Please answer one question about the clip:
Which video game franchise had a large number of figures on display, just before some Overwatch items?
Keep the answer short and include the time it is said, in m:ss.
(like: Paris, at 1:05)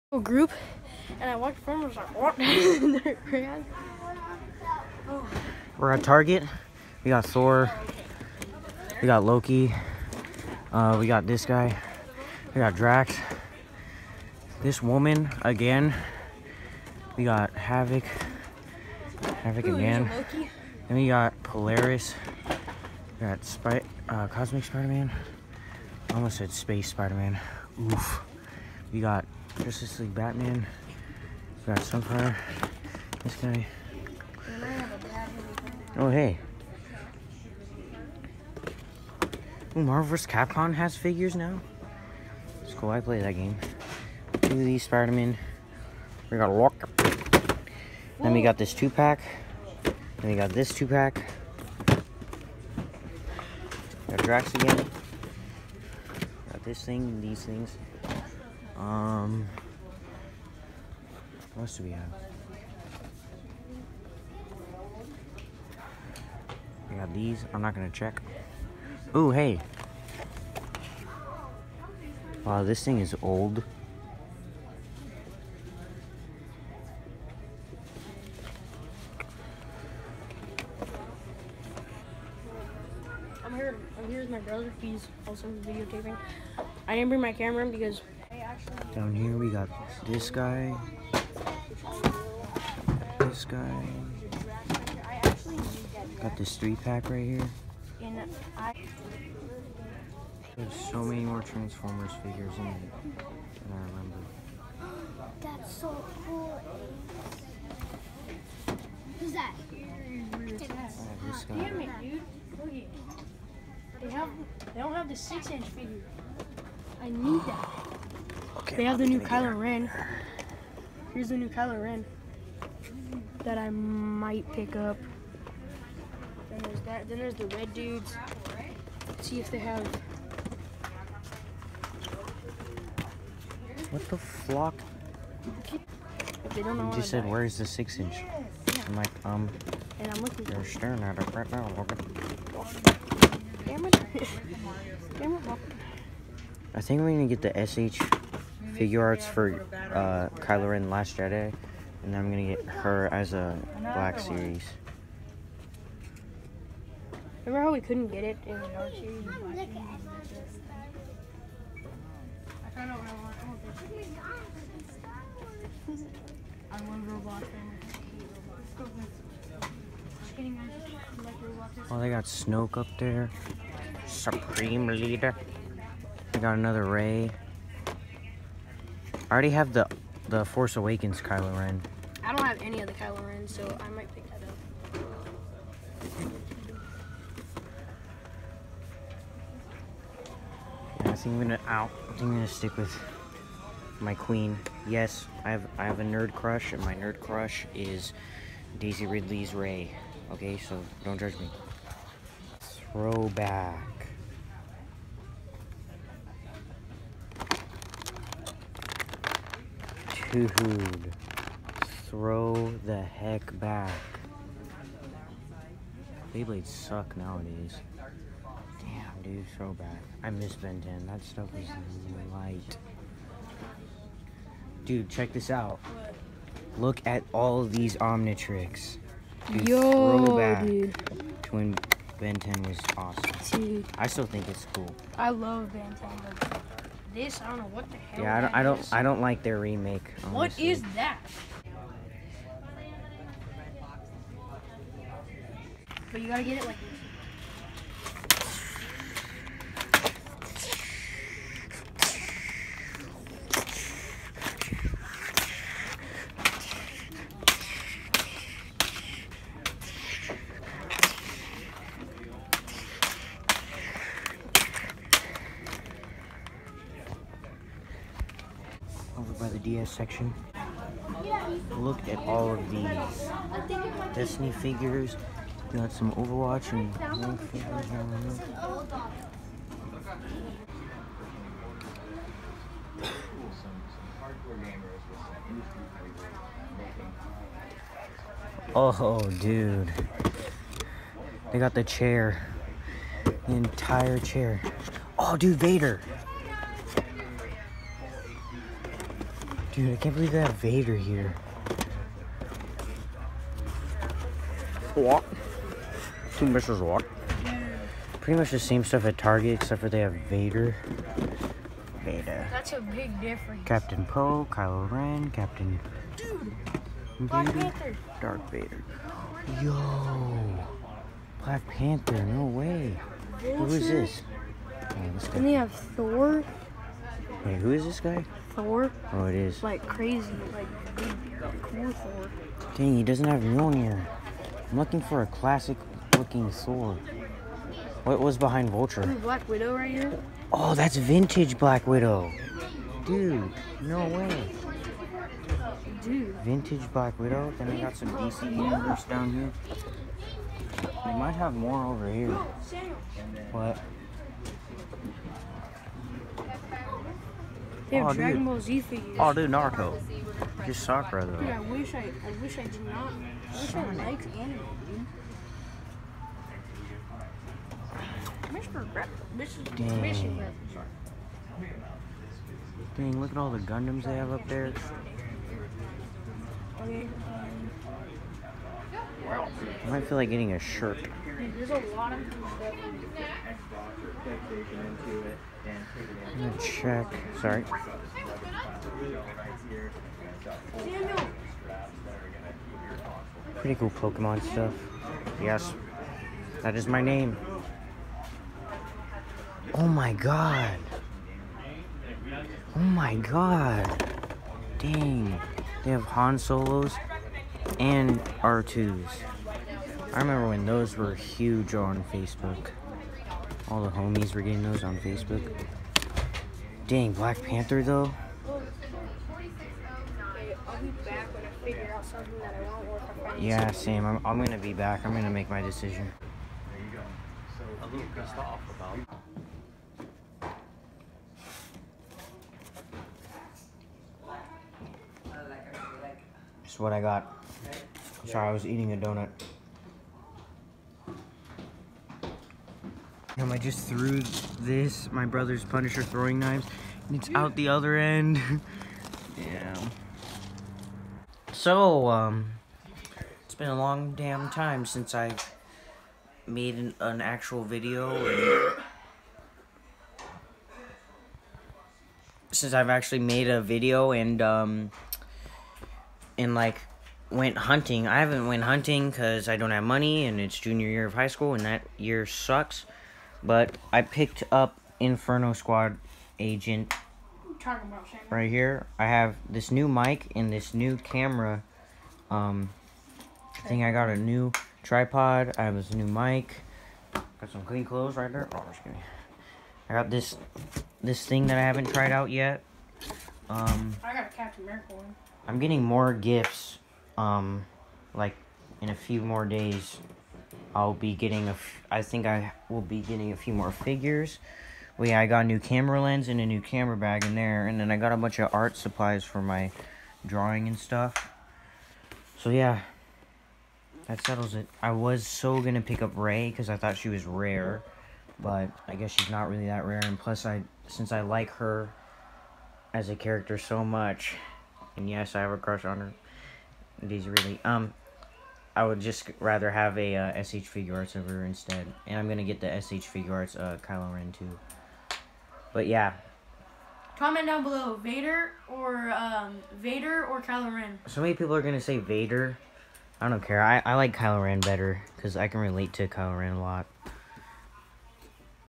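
Destiny, at 4:34.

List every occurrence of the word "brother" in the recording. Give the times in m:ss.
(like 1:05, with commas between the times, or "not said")
1:24, 7:25.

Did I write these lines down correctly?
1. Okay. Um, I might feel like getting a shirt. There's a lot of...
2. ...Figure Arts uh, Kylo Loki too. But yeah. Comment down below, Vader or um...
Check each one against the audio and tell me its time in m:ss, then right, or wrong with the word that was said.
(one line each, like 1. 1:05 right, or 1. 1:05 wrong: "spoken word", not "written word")
1. 6:16 right
2. 8:53 wrong: "Ren", not "Loki".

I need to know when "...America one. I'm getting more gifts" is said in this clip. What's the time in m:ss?
8:14.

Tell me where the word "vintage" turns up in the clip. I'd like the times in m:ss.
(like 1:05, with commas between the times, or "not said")
5:40, 5:46.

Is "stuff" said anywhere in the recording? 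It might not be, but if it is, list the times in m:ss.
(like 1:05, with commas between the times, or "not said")
3:41, 5:08, 6:26, 6:34, 8:30.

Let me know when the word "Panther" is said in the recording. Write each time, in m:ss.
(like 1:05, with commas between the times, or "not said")
5:17, 5:21, 6:57.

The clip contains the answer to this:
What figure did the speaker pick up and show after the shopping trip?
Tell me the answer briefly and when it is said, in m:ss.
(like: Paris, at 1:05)
Inferno Squad Agent, at 7:54.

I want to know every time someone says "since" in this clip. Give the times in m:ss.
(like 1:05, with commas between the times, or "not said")
7:34, 7:42, 8:40.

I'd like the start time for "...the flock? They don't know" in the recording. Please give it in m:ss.
2:14.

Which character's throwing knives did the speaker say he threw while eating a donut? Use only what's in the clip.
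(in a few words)
Punisher.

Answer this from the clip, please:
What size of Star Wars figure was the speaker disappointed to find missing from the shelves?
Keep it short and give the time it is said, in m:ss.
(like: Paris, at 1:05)
6 inch, at 1:55.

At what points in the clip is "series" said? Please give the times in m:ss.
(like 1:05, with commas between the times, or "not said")
2:34, 2:38.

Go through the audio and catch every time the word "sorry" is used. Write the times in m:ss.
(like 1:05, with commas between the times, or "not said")
6:27, 7:18.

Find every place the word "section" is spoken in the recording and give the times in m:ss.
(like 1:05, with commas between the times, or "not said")
4:29.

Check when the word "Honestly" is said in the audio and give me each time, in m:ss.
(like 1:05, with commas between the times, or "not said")
4:00.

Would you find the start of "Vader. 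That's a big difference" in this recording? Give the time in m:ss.
5:12.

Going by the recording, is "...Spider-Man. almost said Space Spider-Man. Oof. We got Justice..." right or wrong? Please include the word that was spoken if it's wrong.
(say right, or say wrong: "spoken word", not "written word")
right.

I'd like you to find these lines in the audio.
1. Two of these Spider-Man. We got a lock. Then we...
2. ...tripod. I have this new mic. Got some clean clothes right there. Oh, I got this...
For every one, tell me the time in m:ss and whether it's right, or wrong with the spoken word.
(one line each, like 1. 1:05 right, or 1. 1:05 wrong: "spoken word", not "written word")
1. 0:44 right
2. 8:04 right.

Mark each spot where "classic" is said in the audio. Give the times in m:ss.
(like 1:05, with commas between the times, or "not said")
5:35.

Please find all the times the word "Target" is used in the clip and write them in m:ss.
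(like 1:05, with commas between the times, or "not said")
0:06, 5:09.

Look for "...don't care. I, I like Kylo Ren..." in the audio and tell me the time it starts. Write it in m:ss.
9:03.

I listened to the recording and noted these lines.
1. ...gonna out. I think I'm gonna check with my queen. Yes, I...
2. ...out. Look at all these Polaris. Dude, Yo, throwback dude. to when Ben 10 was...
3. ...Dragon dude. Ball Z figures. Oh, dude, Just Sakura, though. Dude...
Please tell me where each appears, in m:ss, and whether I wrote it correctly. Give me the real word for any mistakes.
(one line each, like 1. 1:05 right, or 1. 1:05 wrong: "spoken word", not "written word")
1. 3:11 wrong: "stick", not "check"
2. 3:45 wrong: "Omnitricks", not "Polaris"
3. 5:58 right.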